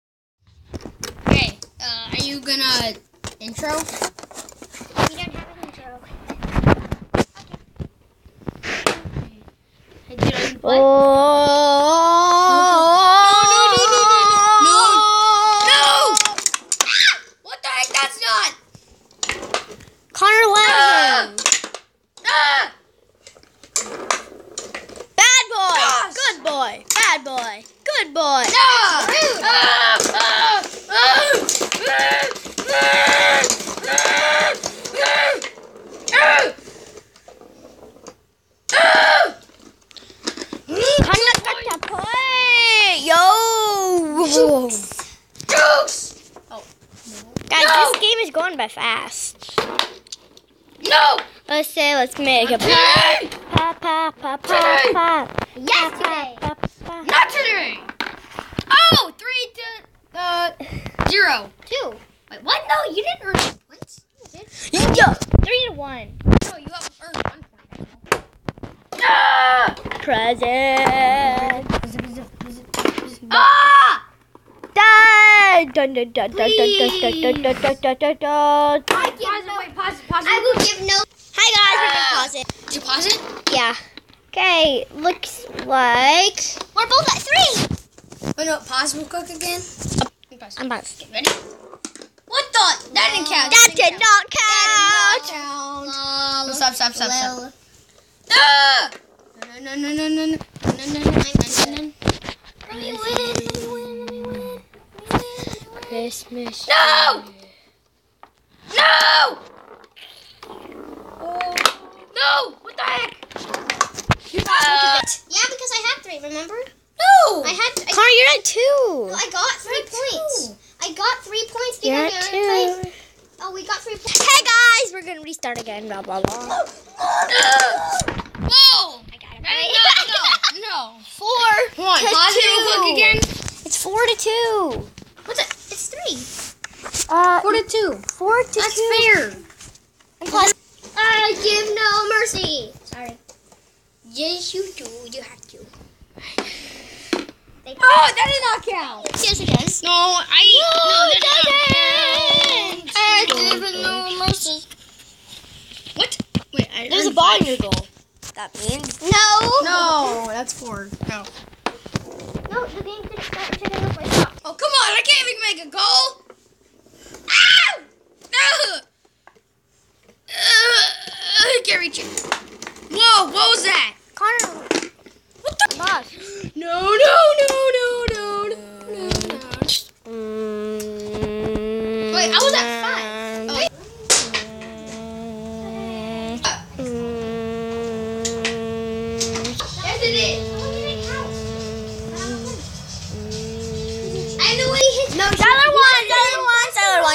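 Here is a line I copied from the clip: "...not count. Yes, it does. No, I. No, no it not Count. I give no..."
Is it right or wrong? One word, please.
right.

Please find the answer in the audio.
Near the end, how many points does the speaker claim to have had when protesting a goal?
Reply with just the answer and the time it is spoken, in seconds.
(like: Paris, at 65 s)
5, at 182 s.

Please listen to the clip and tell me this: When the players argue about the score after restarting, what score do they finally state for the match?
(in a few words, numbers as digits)
4 to 2.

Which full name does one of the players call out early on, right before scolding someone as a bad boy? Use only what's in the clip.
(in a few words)
Connor Lamb.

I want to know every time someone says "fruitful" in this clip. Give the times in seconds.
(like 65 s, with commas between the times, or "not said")
not said.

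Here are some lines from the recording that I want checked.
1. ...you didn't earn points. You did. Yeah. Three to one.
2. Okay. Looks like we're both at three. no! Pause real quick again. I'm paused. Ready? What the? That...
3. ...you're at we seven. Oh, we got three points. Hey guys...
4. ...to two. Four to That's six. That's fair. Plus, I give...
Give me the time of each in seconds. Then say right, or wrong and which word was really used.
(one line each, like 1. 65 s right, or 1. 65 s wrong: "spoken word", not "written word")
1. 62 s right
2. 84 s right
3. 121 s wrong: "two", not "seven"
4. 137 s wrong: "two", not "six".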